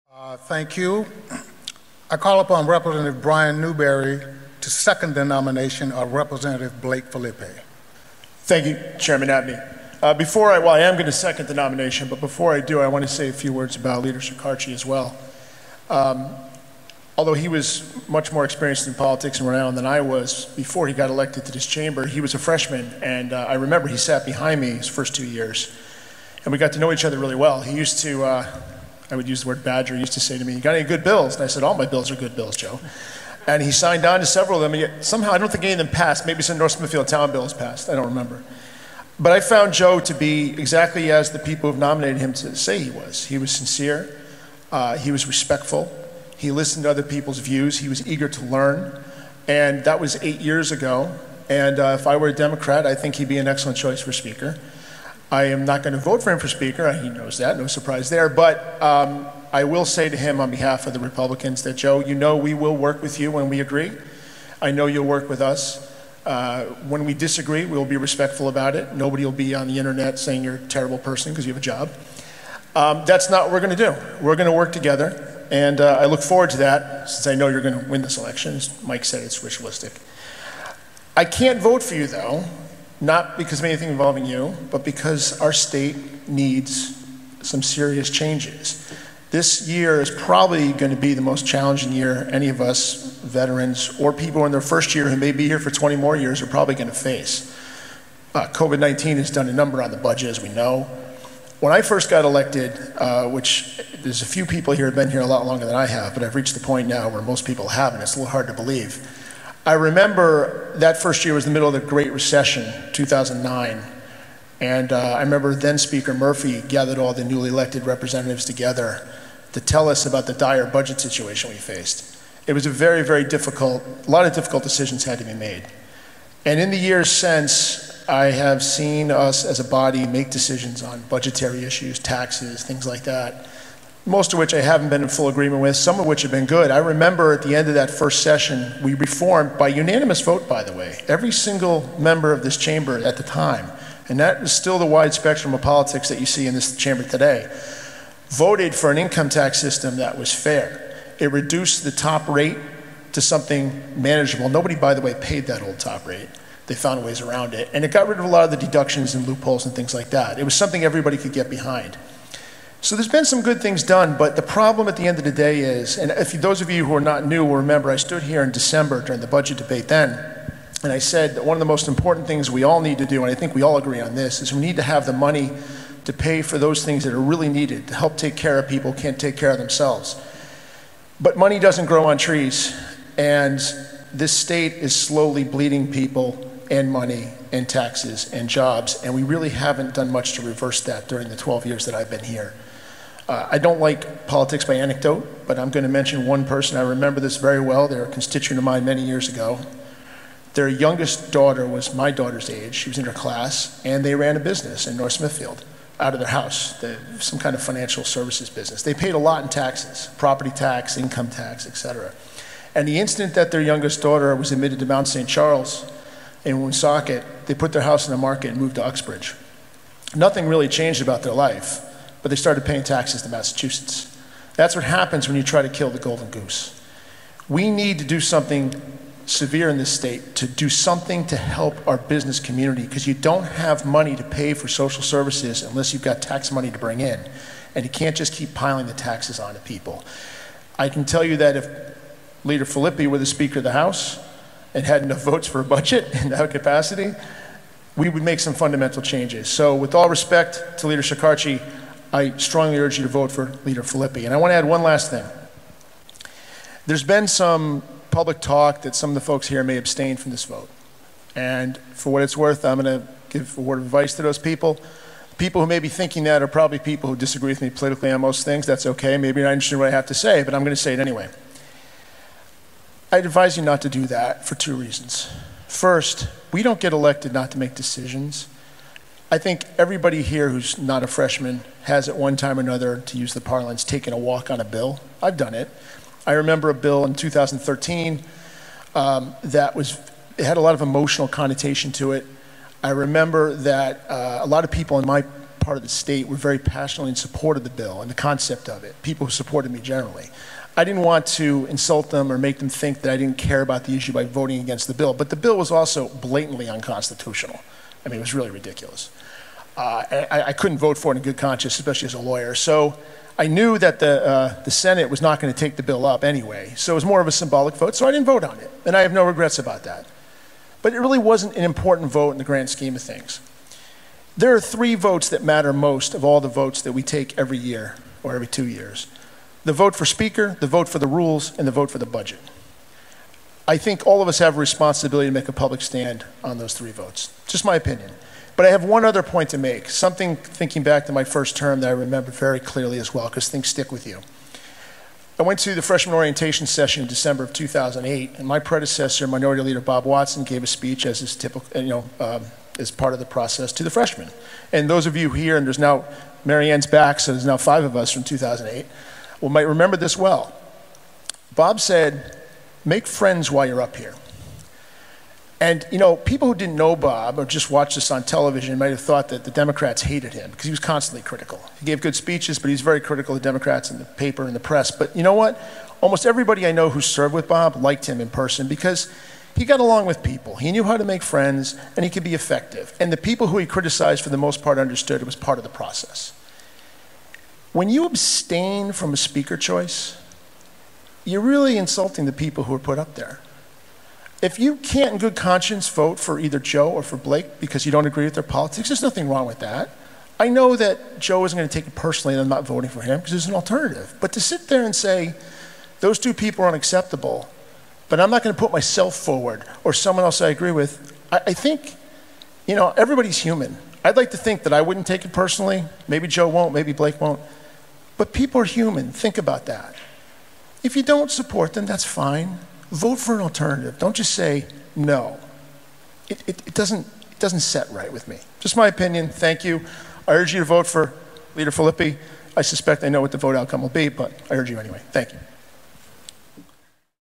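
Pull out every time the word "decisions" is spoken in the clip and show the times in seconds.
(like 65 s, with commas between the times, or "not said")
124 s, 130 s, 277 s.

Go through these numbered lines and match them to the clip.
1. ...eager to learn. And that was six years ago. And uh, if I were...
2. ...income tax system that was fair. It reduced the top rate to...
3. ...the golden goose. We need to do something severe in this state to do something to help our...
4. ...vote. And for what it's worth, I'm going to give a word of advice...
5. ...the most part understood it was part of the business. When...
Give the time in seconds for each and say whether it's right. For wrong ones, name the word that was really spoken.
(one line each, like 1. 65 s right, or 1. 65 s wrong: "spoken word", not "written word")
1. 48 s wrong: "eight", not "six"
2. 148 s right
3. 225 s right
4. 260 s right
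5. 384 s wrong: "process", not "business".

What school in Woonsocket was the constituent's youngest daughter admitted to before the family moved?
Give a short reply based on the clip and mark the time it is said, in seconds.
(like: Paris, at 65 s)
Mount St. Charles, at 214 s.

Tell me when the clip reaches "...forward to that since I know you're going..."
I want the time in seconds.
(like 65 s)
76 s.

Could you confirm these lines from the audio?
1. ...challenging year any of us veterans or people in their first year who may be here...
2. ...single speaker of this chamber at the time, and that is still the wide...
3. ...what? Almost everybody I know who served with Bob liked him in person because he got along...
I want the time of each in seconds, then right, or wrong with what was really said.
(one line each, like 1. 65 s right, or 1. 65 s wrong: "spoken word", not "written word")
1. 91 s right
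2. 141 s wrong: "member", not "speaker"
3. 375 s right.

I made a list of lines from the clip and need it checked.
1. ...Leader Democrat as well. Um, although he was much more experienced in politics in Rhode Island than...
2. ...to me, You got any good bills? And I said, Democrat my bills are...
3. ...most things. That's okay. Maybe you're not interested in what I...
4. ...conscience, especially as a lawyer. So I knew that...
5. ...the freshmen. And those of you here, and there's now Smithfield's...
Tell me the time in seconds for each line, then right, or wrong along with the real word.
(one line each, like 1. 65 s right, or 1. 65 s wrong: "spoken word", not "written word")
1. 14 s wrong: "Shekarchi", not "Democrat"
2. 30 s wrong: "All", not "Democrat"
3. 268 s right
4. 311 s right
5. 353 s wrong: "Marianne", not "Smithfield".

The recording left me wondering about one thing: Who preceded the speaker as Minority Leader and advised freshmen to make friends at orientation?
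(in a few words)
Bob Watson.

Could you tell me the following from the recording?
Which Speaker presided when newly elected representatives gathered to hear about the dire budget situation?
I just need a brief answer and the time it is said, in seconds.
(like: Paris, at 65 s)
Speaker Murphy, at 115 s.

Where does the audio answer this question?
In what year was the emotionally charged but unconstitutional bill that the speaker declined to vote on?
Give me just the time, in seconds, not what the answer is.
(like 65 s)
287 s.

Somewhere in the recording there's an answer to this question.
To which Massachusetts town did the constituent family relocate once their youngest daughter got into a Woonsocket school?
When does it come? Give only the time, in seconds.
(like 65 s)
218 s.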